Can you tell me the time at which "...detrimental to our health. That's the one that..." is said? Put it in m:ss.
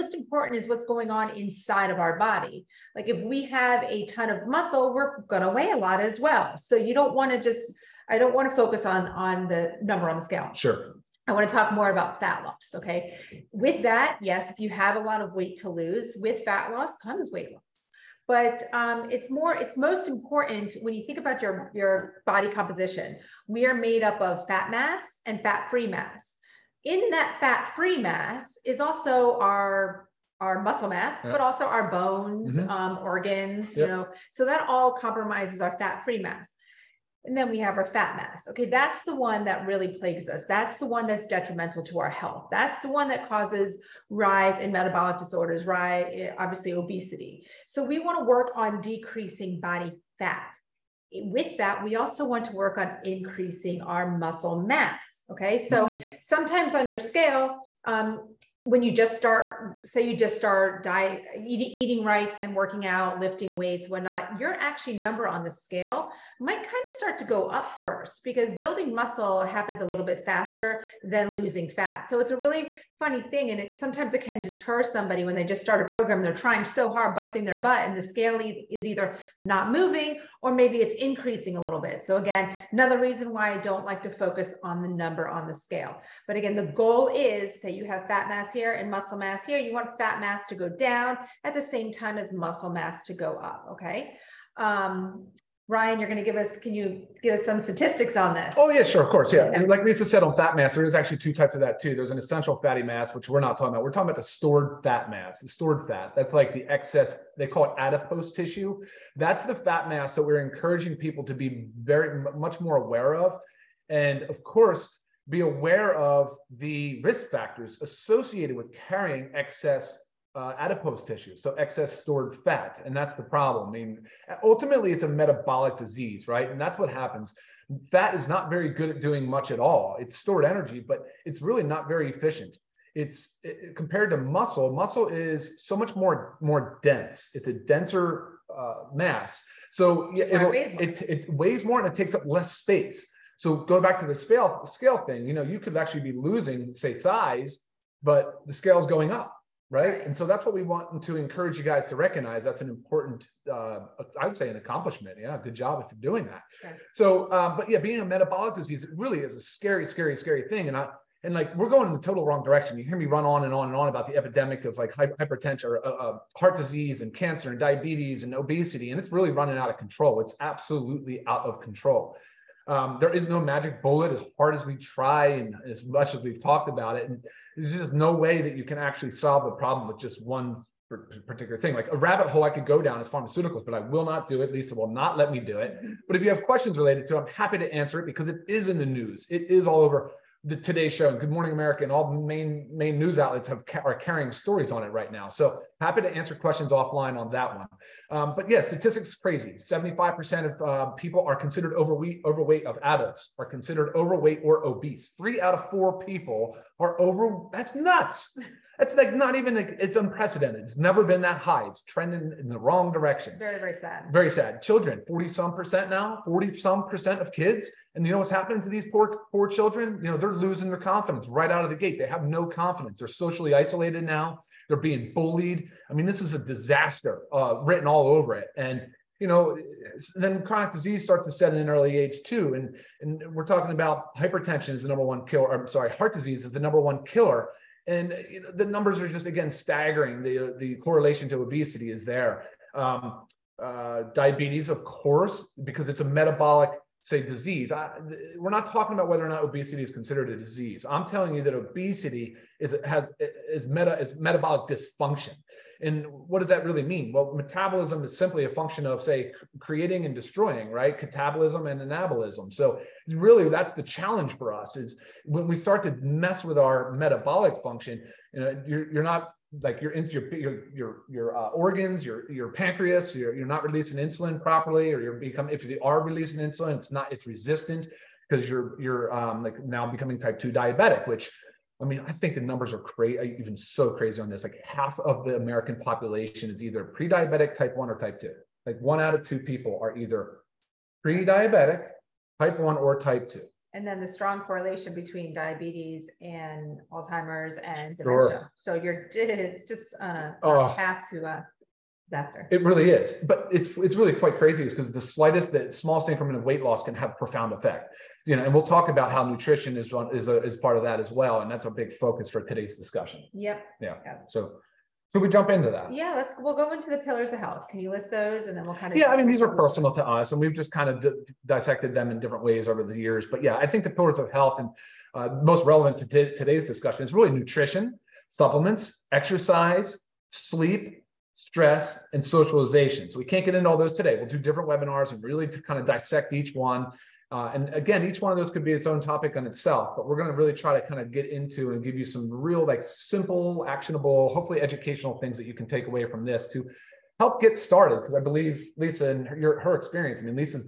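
0:41.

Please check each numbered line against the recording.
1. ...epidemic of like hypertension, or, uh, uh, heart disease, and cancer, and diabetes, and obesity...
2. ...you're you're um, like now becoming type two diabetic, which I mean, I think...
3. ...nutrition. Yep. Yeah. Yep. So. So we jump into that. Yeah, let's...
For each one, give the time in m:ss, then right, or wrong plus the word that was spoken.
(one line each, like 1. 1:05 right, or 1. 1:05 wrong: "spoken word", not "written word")
1. 2:44 right
2. 4:38 right
3. 5:12 wrong: "discussion", not "nutrition".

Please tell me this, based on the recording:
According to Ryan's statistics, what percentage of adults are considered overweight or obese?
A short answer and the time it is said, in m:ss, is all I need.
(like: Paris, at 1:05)
75%, at 3:19.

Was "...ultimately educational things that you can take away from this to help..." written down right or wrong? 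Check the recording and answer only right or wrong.
wrong.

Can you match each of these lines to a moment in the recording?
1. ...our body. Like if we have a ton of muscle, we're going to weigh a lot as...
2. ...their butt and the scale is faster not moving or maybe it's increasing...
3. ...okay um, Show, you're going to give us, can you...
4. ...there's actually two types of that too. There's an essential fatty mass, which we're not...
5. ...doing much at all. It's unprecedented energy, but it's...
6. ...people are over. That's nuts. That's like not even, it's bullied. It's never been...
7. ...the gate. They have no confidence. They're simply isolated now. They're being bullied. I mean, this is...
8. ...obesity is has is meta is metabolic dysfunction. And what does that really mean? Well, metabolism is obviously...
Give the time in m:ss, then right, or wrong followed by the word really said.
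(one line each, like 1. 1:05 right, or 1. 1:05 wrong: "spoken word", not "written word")
1. 0:02 right
2. 1:17 wrong: "either", not "faster"
3. 1:33 wrong: "Ryan", not "Show"
4. 1:40 right
5. 2:09 wrong: "stored", not "unprecedented"
6. 3:26 wrong: "unprecedented", not "bullied"
7. 3:41 wrong: "socially", not "simply"
8. 4:11 wrong: "simply", not "obviously".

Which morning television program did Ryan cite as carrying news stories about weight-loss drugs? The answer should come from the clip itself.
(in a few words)
Today Show.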